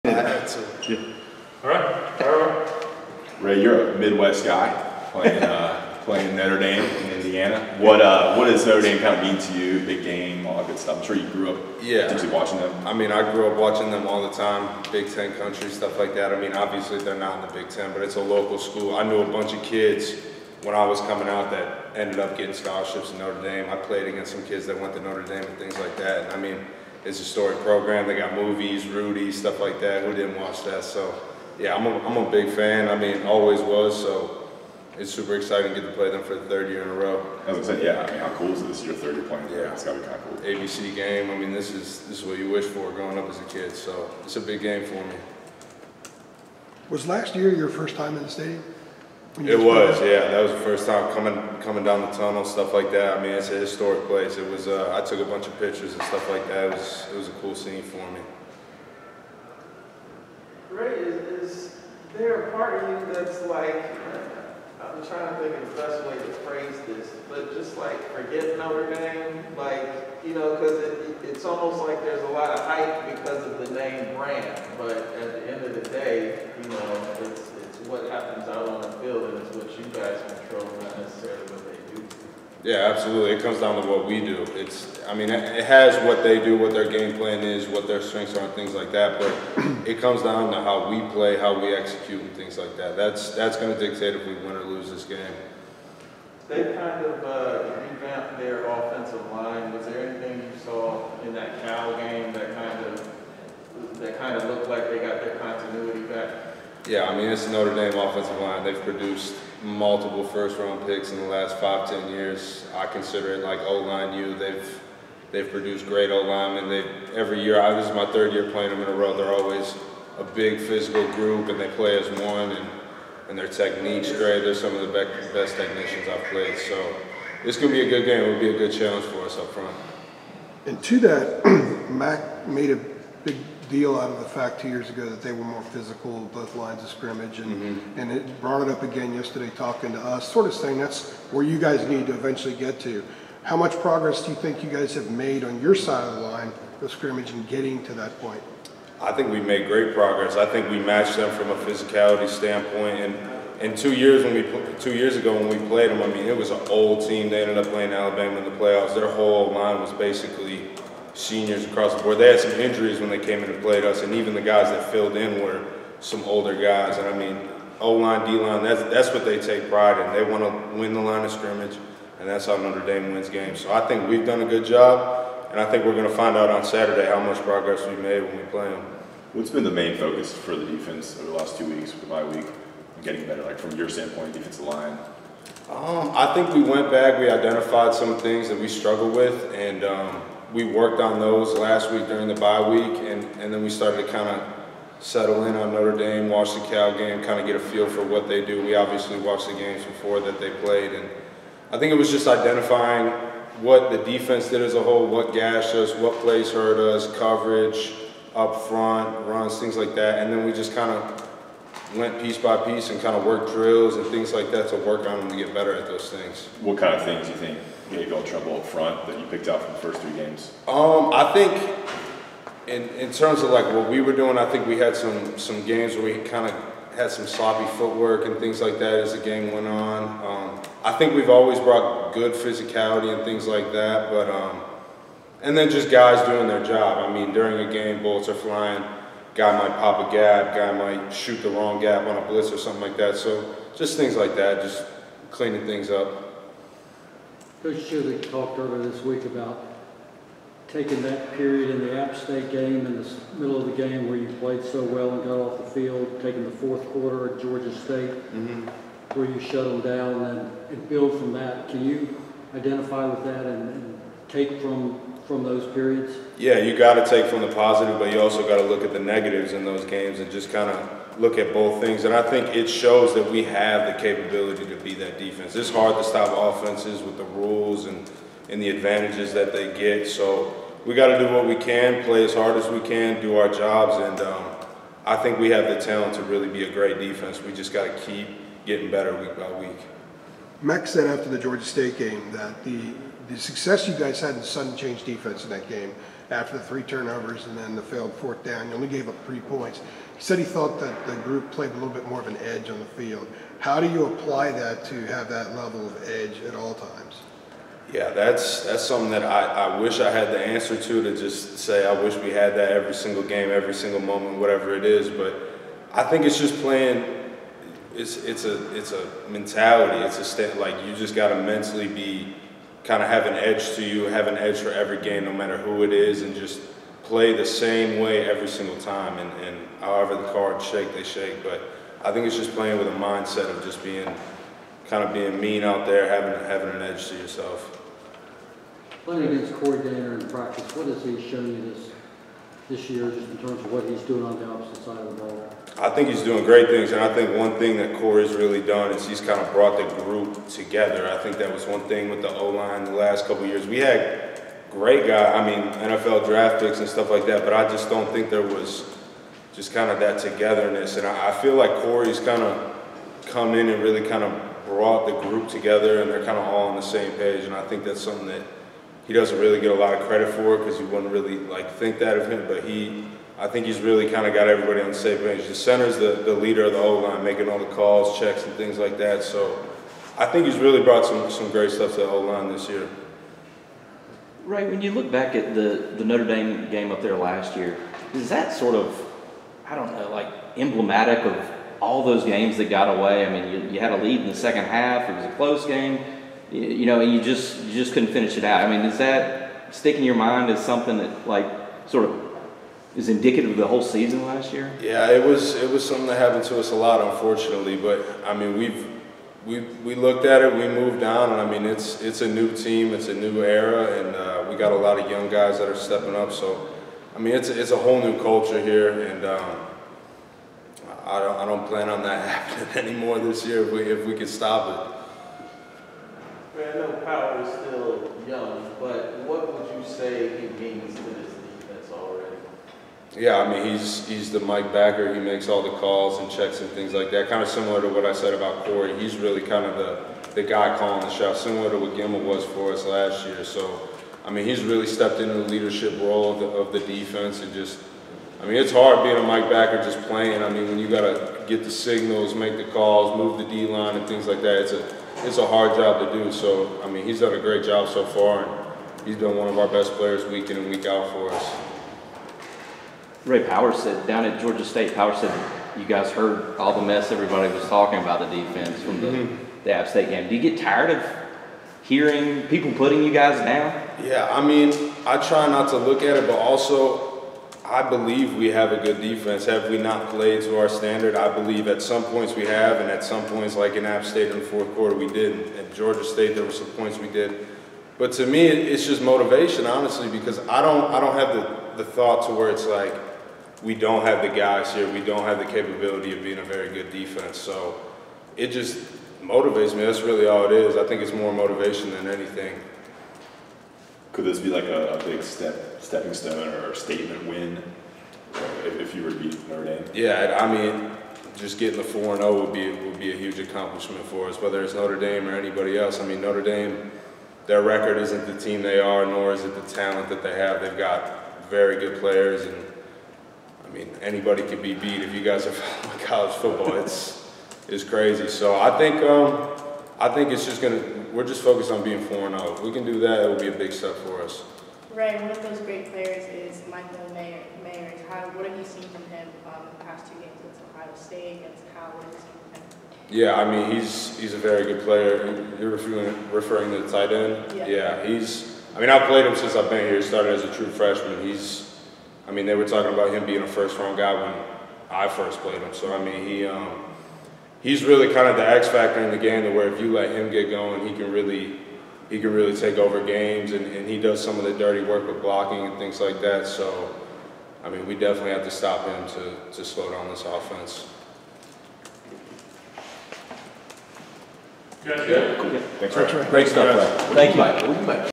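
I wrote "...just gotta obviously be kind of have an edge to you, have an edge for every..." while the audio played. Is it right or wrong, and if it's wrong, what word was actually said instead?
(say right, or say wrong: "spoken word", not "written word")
wrong: "mentally", not "obviously".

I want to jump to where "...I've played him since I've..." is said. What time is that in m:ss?
9:08.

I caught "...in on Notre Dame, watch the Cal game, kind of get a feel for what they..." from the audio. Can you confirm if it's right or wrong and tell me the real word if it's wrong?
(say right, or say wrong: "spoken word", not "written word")
right.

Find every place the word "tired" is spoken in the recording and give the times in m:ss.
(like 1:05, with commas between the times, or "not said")
7:50.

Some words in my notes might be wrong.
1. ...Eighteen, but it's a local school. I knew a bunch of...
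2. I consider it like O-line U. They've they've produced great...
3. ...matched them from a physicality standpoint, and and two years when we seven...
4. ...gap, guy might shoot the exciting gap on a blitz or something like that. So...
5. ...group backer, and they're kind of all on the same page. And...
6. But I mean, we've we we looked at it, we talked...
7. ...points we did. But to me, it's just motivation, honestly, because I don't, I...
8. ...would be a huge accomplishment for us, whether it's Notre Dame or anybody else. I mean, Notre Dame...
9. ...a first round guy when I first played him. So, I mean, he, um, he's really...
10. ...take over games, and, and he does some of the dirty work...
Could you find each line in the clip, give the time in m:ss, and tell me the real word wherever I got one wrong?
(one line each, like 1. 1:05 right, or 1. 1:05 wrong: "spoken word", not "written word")
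1. 0:17 wrong: "Ten", not "Eighteen"
2. 1:52 right
3. 2:30 wrong: "two", not "seven"
4. 4:00 wrong: "wrong", not "exciting"
5. 6:05 wrong: "together", not "backer"
6. 6:47 wrong: "moved", not "talked"
7. 8:06 right
8. 8:32 right
9. 9:13 right
10. 9:22 right.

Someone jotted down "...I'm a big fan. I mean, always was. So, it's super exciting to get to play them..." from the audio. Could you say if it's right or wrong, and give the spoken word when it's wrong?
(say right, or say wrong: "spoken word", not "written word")
right.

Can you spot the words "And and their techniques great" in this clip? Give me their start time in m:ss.
2:02.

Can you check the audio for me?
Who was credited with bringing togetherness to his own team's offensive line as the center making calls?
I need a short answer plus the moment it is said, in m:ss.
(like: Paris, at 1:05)
Corey Gaynor, at 5:39.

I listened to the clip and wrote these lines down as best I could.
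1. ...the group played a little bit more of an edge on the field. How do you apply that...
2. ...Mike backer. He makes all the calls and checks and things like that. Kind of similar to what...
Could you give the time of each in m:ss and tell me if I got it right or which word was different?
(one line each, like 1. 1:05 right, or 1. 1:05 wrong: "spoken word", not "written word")
1. 5:01 right
2. 7:14 right.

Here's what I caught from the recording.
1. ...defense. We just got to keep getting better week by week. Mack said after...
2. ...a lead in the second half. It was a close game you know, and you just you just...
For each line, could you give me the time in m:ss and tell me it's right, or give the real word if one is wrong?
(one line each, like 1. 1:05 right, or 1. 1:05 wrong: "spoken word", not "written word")
1. 4:46 right
2. 6:33 right.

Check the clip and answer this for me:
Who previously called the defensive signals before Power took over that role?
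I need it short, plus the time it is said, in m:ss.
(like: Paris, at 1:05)
Gemmel, at 7:21.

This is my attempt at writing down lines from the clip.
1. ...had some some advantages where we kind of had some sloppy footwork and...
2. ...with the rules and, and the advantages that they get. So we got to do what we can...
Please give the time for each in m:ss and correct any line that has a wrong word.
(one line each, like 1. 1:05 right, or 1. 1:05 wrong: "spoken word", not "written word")
1. 3:44 wrong: "games", not "advantages"
2. 4:37 right.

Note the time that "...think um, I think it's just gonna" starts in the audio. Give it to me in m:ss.
8:48.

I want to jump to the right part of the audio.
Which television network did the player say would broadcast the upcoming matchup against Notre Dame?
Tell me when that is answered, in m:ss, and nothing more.
0:40.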